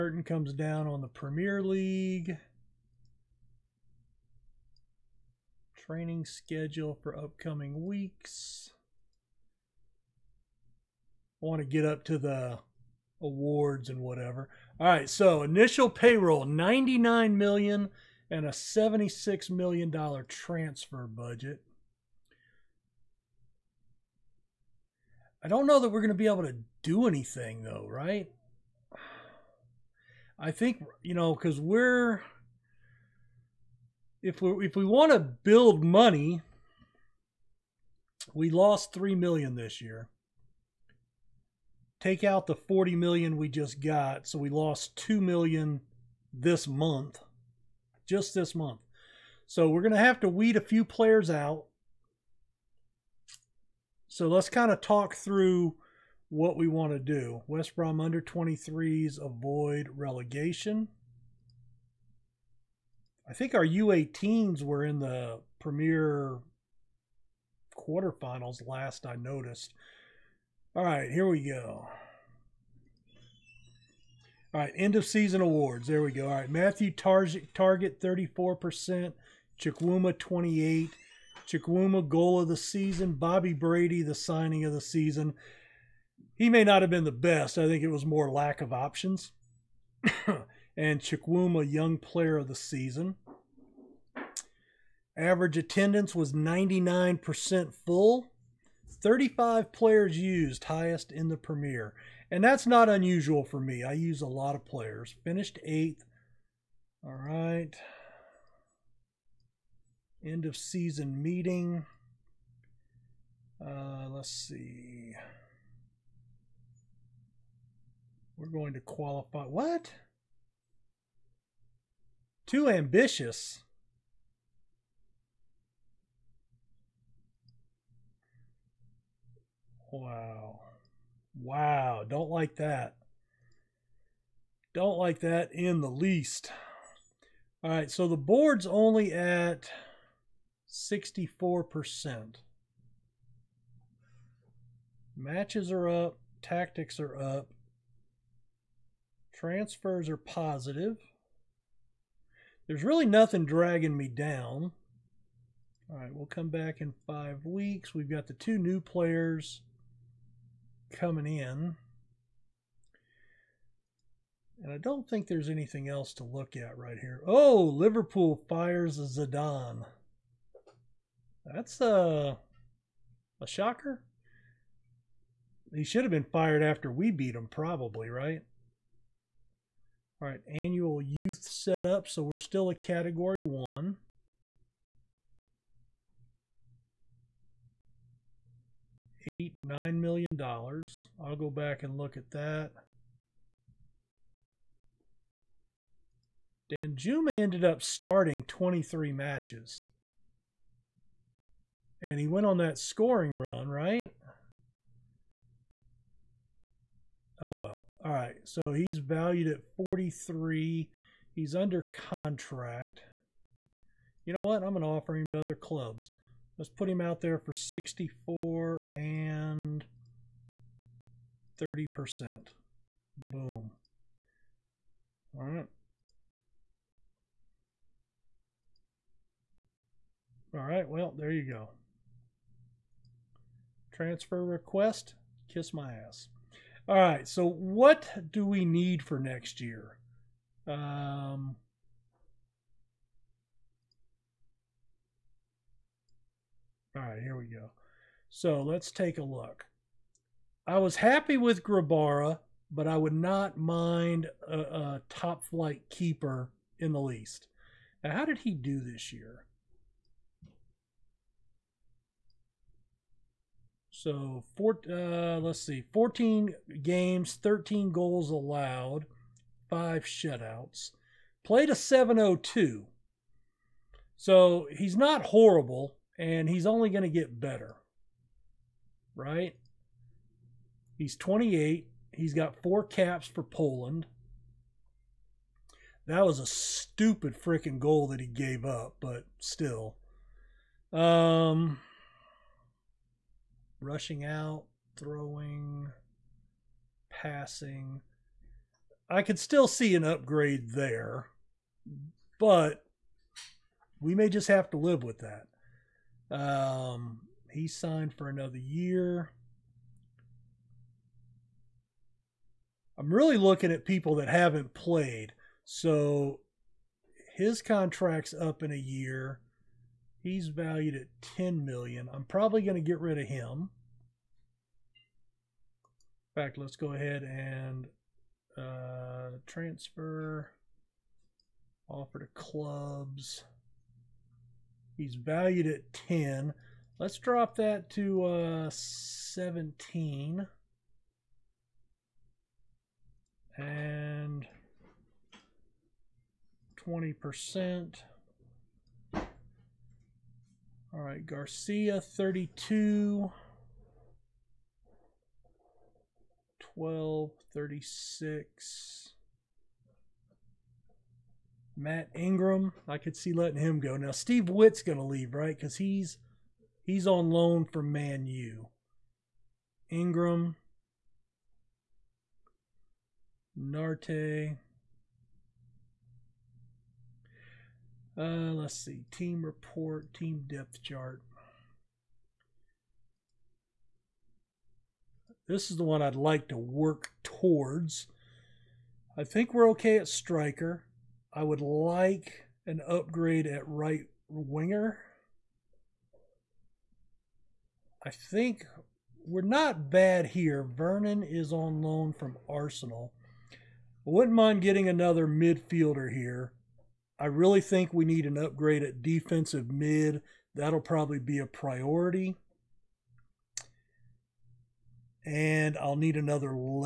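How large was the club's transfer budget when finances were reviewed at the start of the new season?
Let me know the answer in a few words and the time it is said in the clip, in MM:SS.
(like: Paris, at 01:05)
$76 million, at 00:18.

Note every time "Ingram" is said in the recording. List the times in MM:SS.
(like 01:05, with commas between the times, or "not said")
06:02, 06:09.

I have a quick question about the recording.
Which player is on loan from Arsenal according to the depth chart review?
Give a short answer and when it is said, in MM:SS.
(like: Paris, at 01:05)
Vernon, at 06:40.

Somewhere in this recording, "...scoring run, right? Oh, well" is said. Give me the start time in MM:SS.
03:22.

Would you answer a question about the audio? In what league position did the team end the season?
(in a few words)
Eighth.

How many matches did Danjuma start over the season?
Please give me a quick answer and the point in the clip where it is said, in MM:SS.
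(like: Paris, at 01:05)
23, at 03:18.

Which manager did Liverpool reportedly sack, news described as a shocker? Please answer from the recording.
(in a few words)
Zidane.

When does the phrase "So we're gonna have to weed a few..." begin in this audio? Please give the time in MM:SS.
00:49.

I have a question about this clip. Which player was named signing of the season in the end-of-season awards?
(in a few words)
Bobby Brady.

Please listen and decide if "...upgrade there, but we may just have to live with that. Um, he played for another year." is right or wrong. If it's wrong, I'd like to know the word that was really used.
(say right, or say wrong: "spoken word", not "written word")
wrong: "signed", not "played".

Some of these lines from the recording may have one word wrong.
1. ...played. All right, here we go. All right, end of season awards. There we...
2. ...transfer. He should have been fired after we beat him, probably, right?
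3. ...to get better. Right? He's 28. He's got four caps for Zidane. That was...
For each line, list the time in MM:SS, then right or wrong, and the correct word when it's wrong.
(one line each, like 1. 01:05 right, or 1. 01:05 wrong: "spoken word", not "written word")
1. 01:09 wrong: "noticed", not "played"
2. 02:53 wrong: "shocker", not "transfer"
3. 04:37 wrong: "Poland", not "Zidane".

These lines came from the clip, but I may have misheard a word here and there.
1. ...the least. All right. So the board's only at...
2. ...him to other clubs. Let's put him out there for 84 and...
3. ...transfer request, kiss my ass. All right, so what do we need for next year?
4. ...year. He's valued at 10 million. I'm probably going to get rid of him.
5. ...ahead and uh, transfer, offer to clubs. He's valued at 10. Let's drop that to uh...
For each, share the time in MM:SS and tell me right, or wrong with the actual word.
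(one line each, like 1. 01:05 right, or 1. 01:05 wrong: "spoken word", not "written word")
1. 02:15 right
2. 03:35 wrong: "64", not "84"
3. 03:53 right
4. 05:18 right
5. 05:26 right.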